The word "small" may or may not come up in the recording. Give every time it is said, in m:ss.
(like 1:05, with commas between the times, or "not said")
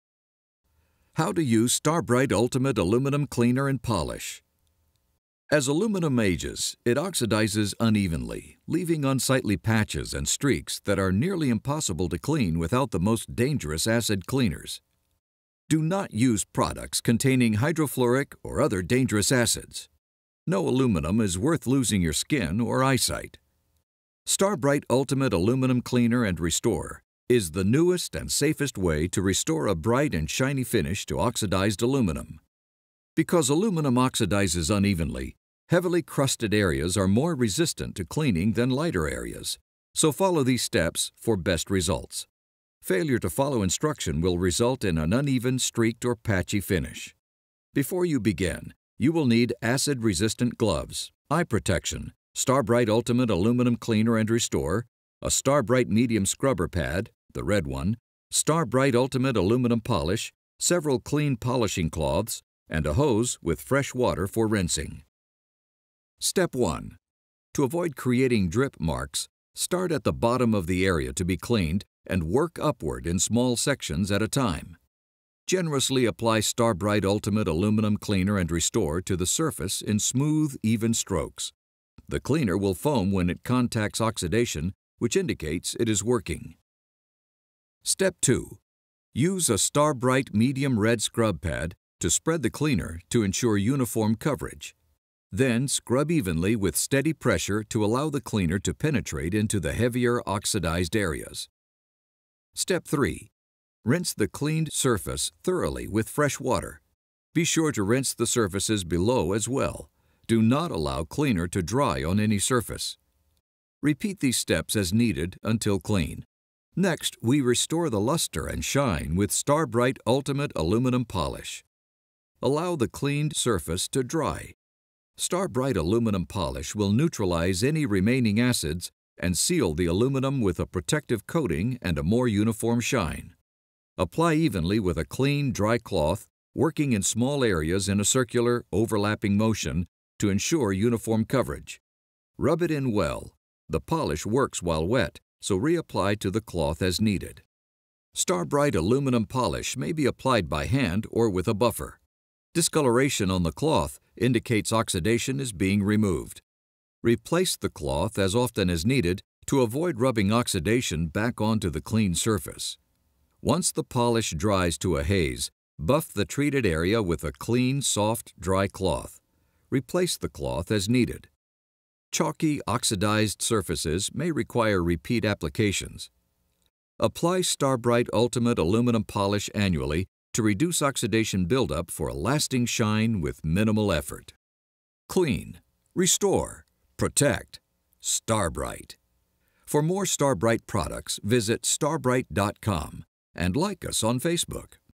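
1:13, 2:17.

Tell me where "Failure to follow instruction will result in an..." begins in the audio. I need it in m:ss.
0:42.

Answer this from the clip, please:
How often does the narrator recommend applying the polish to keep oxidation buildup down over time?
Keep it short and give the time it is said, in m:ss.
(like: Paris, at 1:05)
annually, at 2:59.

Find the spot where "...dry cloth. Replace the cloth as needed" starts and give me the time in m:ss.
2:48.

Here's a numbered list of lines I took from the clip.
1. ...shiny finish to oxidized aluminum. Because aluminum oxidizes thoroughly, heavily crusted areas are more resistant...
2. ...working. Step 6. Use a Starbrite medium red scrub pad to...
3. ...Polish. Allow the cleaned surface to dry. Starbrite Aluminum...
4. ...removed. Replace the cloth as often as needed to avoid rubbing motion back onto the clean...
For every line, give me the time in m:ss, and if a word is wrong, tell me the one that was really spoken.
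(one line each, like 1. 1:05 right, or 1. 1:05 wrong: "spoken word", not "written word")
1. 0:30 wrong: "unevenly", not "thoroughly"
2. 1:26 wrong: "2", not "6"
3. 2:01 right
4. 2:35 wrong: "oxidation", not "motion".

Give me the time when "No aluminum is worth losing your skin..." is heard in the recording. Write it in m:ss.
0:20.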